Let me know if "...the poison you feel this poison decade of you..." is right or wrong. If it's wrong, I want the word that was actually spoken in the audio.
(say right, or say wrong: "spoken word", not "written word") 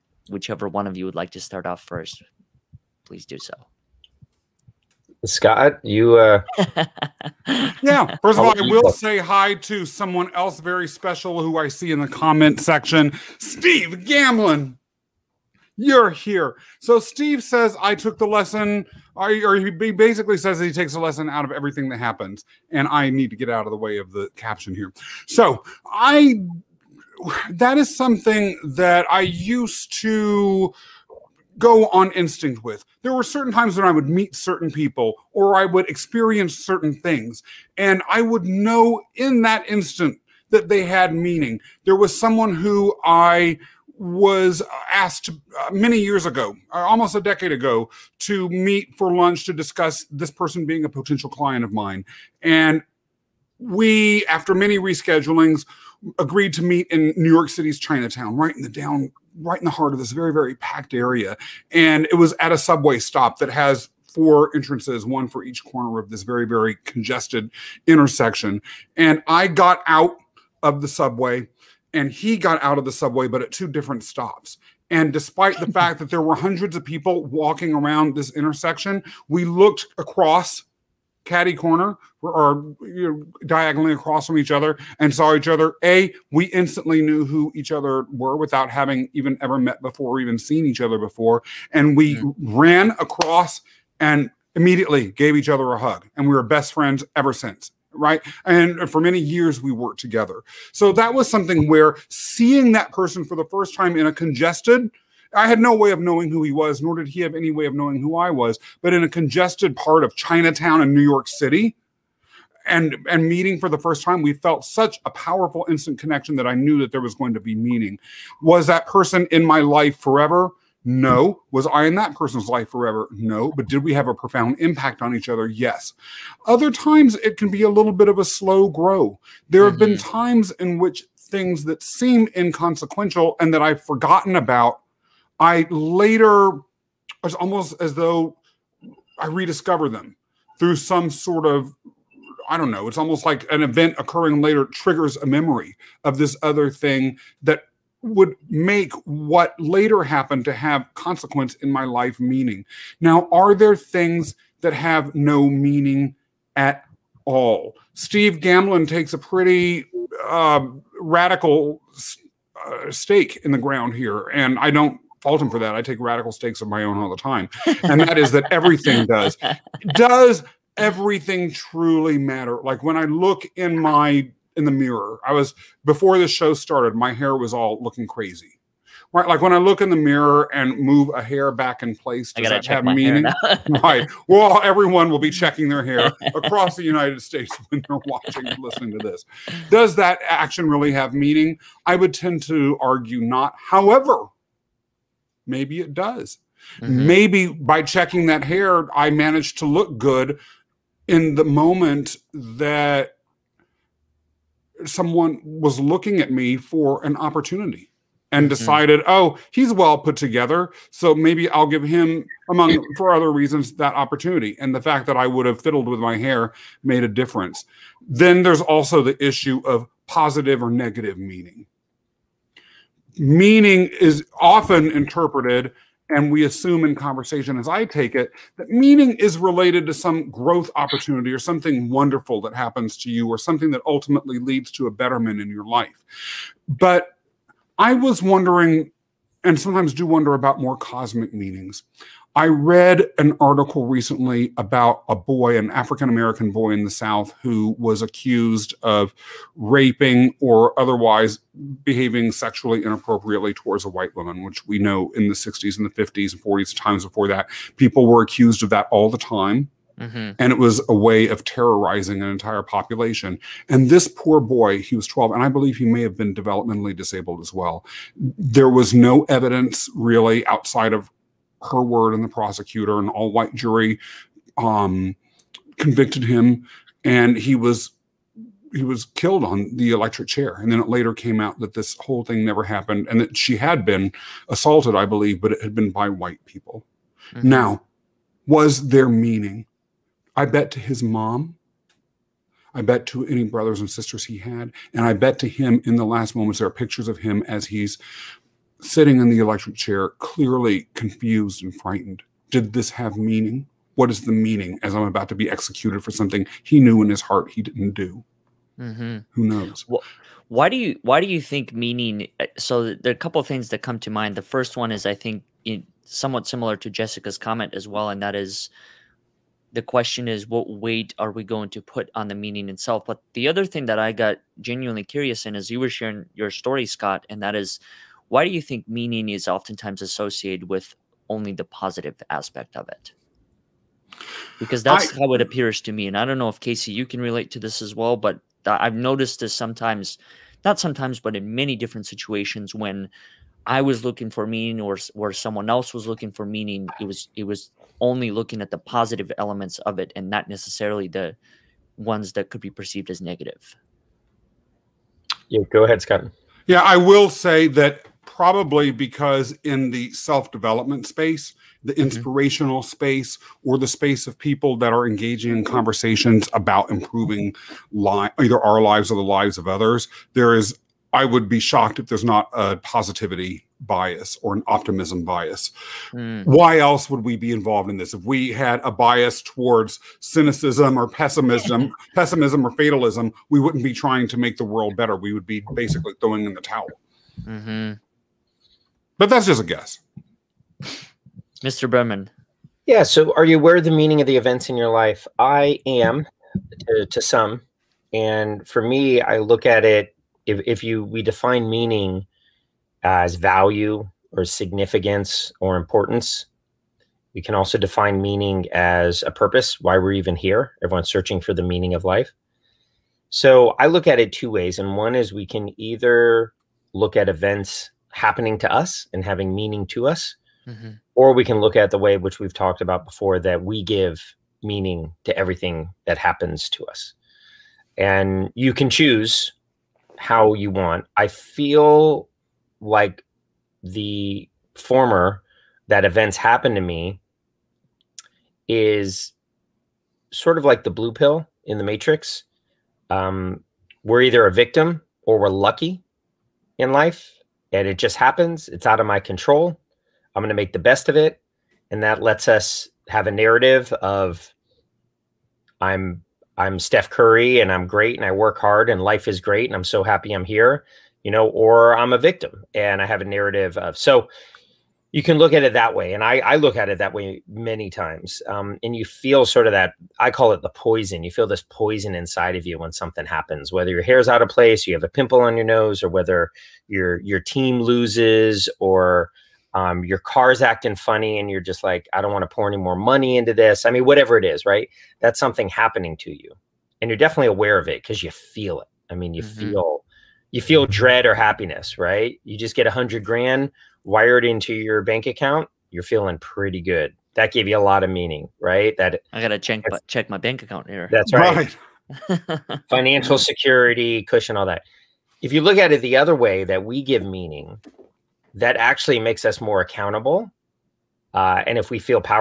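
wrong: "inside", not "decade".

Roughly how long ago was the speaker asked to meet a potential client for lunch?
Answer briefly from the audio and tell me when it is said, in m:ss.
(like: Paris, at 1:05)
almost a decade, at 0:46.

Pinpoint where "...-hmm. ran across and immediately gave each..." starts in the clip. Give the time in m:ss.
1:32.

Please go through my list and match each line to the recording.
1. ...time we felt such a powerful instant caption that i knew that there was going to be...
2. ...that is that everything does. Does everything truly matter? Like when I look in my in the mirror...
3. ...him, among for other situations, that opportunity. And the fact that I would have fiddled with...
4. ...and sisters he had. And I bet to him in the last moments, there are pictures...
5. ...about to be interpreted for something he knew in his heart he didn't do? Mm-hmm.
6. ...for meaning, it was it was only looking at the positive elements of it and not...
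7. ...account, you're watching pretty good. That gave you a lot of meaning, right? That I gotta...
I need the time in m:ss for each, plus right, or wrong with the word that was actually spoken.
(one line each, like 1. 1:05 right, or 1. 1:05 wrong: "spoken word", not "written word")
1. 1:54 wrong: "connection", not "caption"
2. 2:48 right
3. 3:31 wrong: "reasons", not "situations"
4. 4:53 right
5. 5:05 wrong: "executed", not "interpreted"
6. 5:46 right
7. 8:15 wrong: "feeling", not "watching".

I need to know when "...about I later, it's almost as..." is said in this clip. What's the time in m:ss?
2:14.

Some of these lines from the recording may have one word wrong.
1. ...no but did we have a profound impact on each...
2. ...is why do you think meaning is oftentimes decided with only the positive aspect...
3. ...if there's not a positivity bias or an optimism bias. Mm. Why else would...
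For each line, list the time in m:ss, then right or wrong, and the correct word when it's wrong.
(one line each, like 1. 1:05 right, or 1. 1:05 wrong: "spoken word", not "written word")
1. 2:03 right
2. 5:27 wrong: "associated", not "decided"
3. 6:11 right.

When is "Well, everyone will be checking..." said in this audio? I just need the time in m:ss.
3:04.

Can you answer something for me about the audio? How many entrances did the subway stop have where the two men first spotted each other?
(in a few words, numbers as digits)
4.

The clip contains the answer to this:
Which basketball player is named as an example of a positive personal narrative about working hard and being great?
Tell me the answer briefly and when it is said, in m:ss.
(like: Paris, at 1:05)
Steph Curry, at 7:36.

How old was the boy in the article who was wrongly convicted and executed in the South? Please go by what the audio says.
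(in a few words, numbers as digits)
12.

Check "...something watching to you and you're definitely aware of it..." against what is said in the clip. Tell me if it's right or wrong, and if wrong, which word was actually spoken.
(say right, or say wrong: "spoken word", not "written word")
wrong: "happening", not "watching".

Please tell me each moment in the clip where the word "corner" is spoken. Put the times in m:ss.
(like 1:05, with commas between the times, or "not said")
1:05, 1:21.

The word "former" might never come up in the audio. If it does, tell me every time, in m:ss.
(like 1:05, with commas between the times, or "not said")
7:14.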